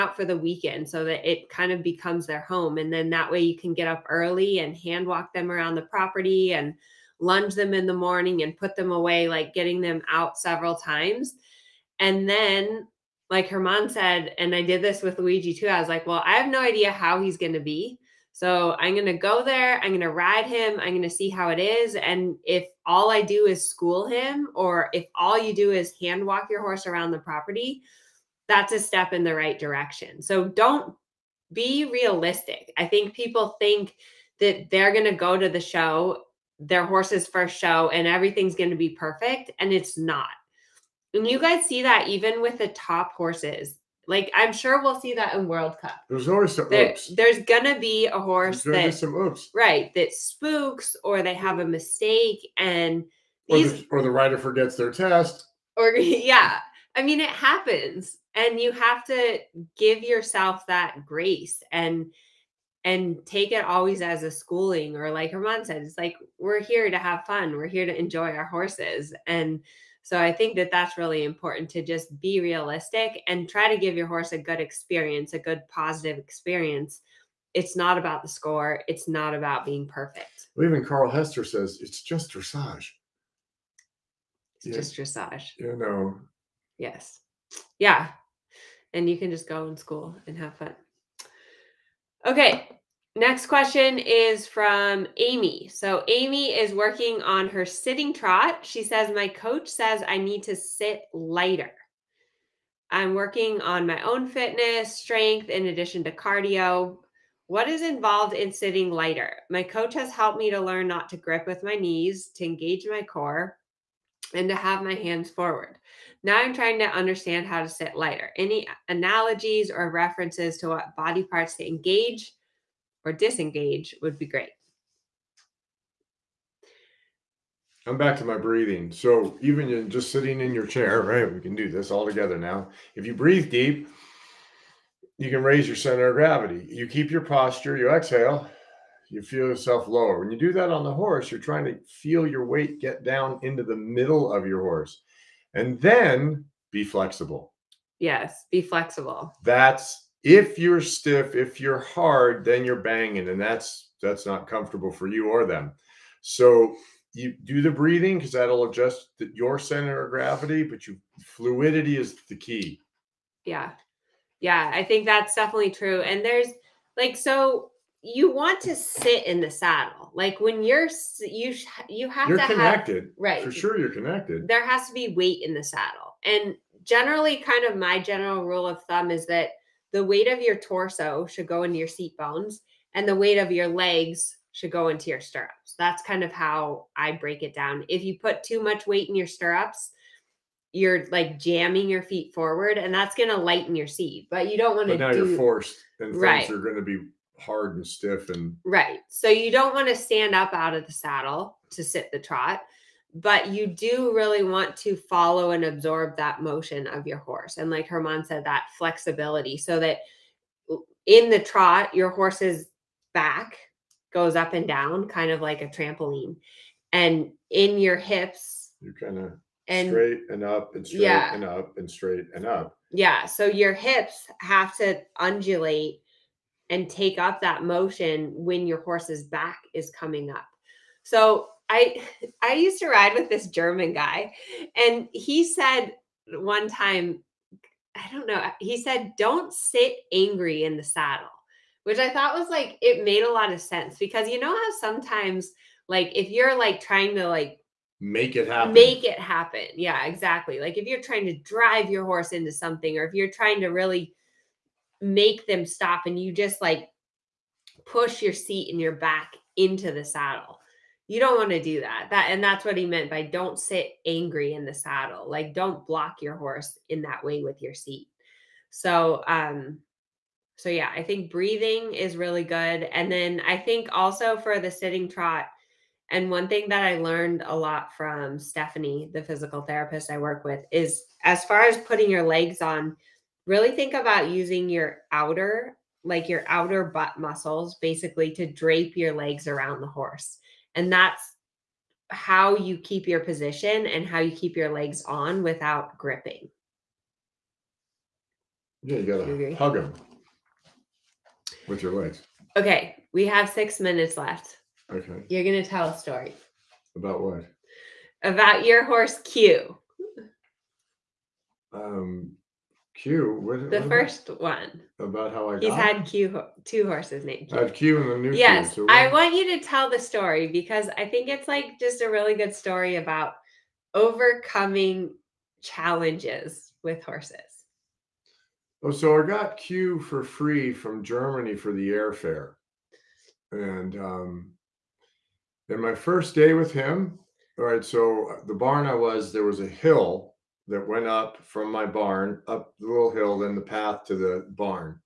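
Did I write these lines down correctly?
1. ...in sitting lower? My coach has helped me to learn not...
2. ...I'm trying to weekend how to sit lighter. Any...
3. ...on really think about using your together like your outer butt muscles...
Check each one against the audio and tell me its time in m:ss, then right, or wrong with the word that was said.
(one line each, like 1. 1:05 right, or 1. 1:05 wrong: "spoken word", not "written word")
1. 1:48 wrong: "lighter", not "lower"
2. 1:56 wrong: "understand", not "weekend"
3. 4:42 wrong: "outer", not "together".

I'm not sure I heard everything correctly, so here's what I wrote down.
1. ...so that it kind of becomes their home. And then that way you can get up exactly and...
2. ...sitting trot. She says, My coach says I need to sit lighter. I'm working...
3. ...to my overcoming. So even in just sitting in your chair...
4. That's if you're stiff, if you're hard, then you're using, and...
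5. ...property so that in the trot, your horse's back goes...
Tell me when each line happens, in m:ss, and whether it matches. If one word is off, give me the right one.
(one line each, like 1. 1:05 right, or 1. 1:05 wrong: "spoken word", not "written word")
1. 0:00 wrong: "early", not "exactly"
2. 1:37 right
3. 2:08 wrong: "breathing", not "overcoming"
4. 2:29 wrong: "banging", not "using"
5. 3:28 wrong: "flexibility", not "property".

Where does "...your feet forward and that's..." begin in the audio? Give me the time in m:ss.
3:11.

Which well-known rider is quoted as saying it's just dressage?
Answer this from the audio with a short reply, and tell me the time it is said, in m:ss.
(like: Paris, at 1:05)
Carl Hester, at 1:20.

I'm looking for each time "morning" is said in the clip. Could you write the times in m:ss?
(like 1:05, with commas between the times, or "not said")
0:07.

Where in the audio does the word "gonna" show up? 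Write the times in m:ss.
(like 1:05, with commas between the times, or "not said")
0:47, 5:05.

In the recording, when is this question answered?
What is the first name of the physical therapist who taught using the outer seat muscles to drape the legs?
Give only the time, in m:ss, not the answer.
4:38.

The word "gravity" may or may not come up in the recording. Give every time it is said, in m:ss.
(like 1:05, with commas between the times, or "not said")
2:16, 2:40.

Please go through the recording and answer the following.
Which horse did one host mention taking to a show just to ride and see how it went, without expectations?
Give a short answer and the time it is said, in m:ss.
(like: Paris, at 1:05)
Luigi, at 0:15.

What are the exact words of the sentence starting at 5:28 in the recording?
Oh, so I got Q for free from Germany for the airfare.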